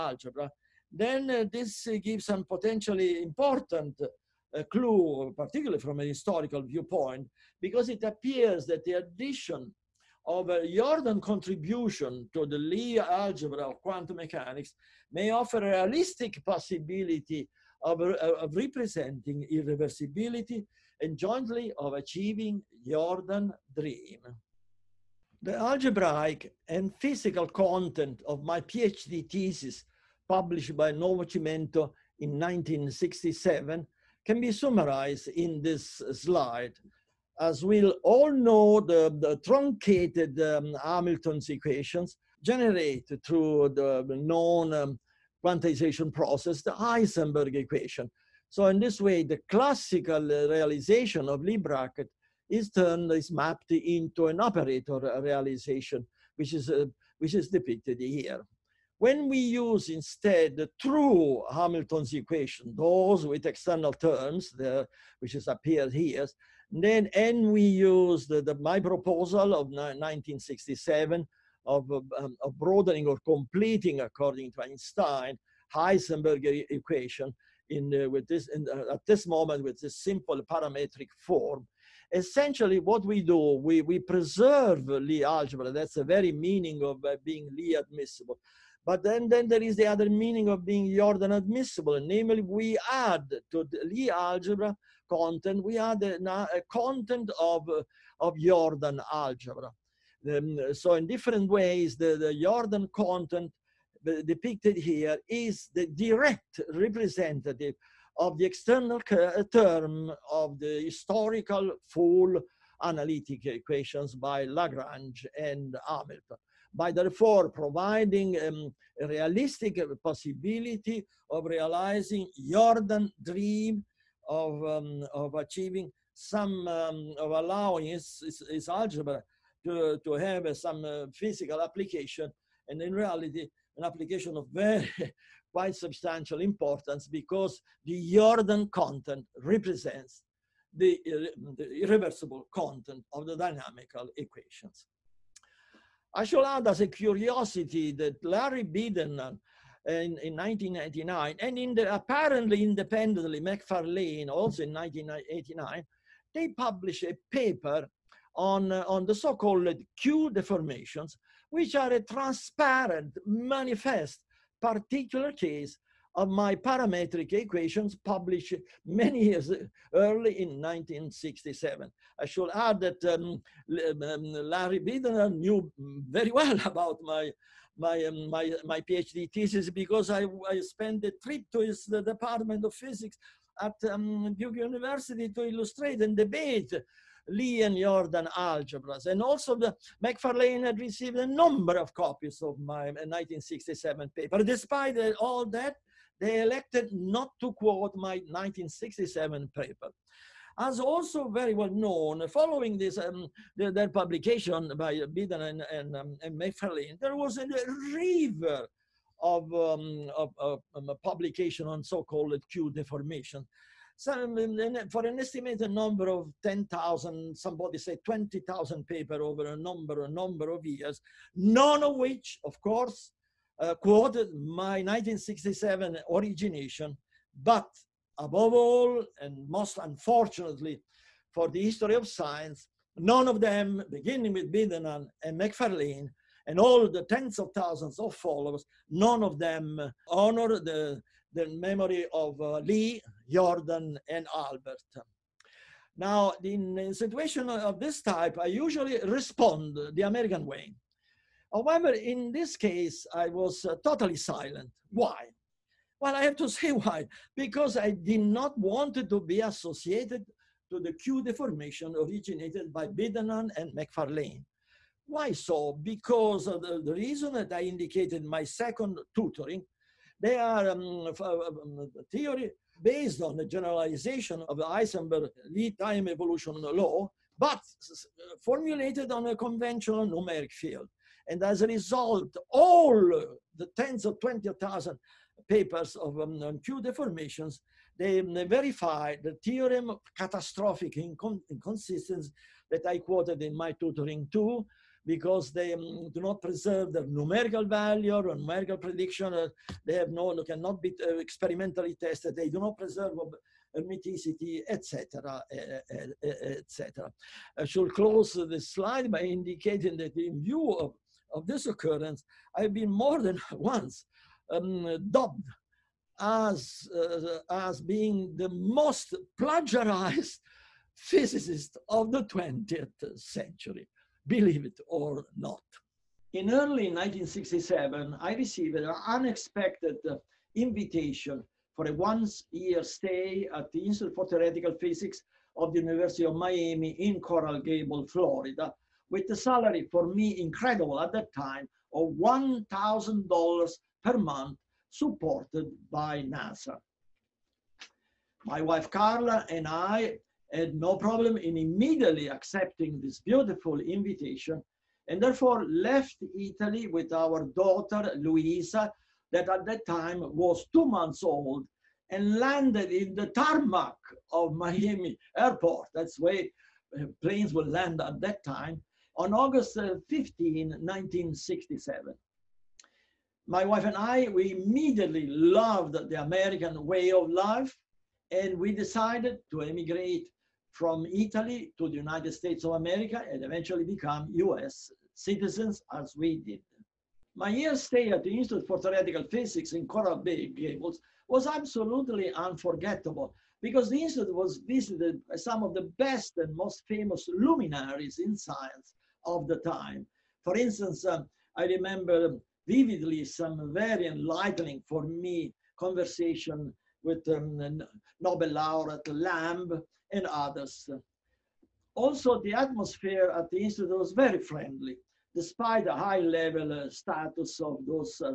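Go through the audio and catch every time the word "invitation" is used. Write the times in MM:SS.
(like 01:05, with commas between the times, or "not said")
05:30, 05:53.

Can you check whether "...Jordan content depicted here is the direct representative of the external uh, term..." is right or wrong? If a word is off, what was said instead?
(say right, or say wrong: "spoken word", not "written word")
right.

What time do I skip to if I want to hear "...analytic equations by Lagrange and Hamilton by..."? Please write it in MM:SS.
01:52.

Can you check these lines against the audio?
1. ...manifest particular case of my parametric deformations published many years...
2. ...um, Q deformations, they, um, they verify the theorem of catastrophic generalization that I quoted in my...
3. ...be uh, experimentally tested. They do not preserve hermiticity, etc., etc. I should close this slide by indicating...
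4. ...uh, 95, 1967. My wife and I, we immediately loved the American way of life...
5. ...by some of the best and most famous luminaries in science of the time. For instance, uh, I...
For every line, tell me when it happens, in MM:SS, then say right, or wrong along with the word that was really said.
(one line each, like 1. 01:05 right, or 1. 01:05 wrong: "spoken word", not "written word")
1. 02:43 wrong: "equations", not "deformations"
2. 04:46 wrong: "incon", not "generalization"
3. 05:00 right
4. 06:09 wrong: "15", not "95"
5. 06:35 right.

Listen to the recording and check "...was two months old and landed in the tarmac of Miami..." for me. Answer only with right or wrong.
right.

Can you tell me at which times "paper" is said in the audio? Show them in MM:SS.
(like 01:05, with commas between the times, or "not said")
02:37, 03:14, 03:19, 03:38, 04:45.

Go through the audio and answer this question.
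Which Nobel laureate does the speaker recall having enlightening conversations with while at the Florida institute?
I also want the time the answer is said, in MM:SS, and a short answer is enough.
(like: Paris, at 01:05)
Lamb, at 06:49.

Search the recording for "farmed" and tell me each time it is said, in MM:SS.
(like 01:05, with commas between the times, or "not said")
not said.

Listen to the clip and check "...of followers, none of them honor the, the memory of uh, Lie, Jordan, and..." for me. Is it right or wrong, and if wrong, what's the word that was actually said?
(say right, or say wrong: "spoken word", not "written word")
right.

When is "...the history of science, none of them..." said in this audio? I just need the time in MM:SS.
03:51.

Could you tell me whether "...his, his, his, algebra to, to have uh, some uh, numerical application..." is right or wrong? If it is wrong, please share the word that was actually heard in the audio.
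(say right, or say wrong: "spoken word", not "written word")
wrong: "physical", not "numerical".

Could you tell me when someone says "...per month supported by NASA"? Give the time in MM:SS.
05:44.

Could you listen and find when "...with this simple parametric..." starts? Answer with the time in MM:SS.
01:19.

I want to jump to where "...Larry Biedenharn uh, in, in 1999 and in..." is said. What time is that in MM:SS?
02:28.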